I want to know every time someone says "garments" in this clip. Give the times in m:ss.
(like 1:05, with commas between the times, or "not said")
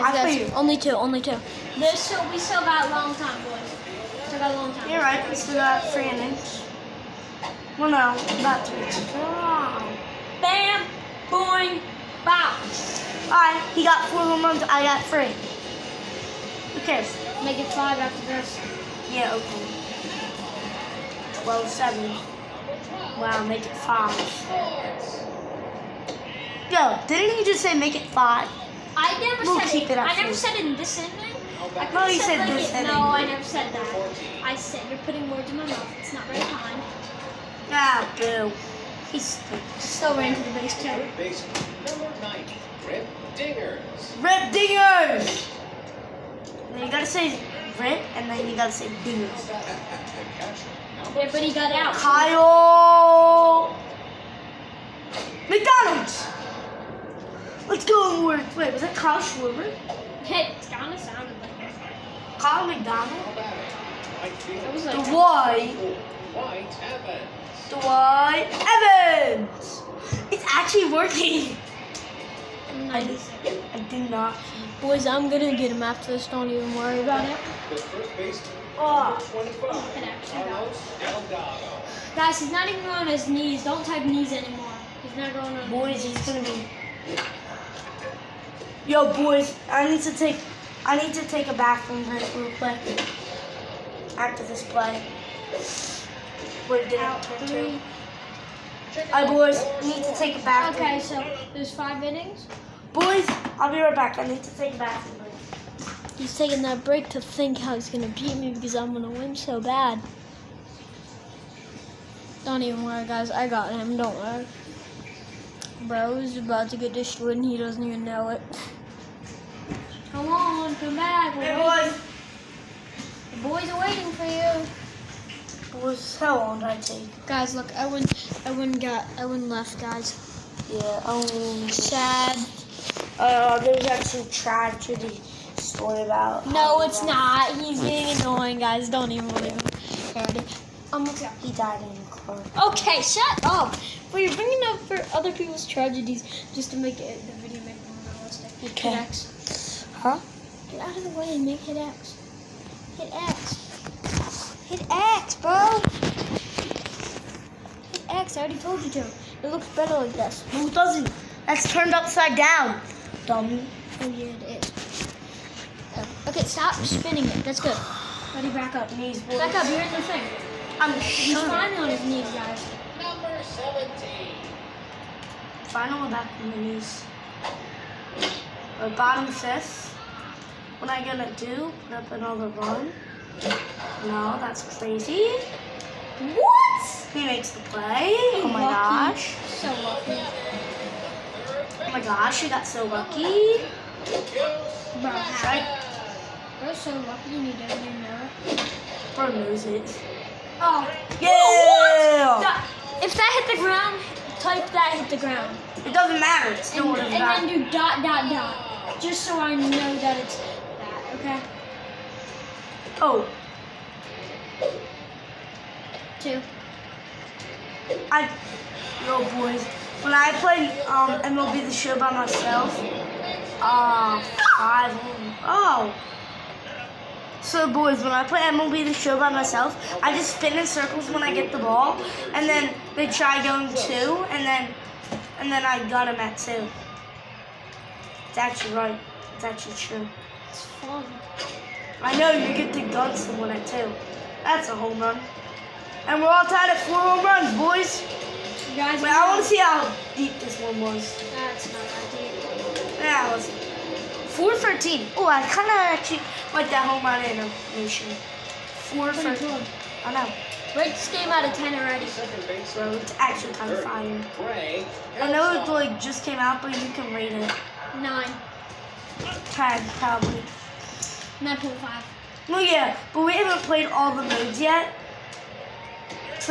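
not said.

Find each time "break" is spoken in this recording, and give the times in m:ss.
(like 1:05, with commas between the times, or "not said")
1:32, 1:46.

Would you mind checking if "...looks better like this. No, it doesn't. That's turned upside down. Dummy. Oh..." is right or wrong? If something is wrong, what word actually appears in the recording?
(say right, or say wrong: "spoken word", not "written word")
right.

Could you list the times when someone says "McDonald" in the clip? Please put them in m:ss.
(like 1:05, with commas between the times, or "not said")
0:55, 1:02.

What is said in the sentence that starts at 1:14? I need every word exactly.
Boys, I'm gonna get him after this.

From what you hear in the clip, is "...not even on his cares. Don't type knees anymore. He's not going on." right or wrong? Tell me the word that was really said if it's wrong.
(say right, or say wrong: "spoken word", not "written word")
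wrong: "knees", not "cares".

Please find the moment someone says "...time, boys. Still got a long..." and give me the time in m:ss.
0:03.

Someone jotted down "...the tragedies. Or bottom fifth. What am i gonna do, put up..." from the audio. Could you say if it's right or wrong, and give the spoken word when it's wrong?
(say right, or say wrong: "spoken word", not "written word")
wrong: "knees", not "tragedies".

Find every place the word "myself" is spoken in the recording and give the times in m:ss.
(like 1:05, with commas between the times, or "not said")
3:42, 3:49.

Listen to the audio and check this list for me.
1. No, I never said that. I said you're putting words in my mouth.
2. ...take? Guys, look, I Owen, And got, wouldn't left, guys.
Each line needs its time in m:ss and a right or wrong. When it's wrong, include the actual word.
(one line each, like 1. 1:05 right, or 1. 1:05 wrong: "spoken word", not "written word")
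1. 0:32 right
2. 2:06 wrong: "Owen", not "And".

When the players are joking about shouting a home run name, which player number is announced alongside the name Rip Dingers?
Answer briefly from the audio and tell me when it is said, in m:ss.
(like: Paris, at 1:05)
90, at 0:41.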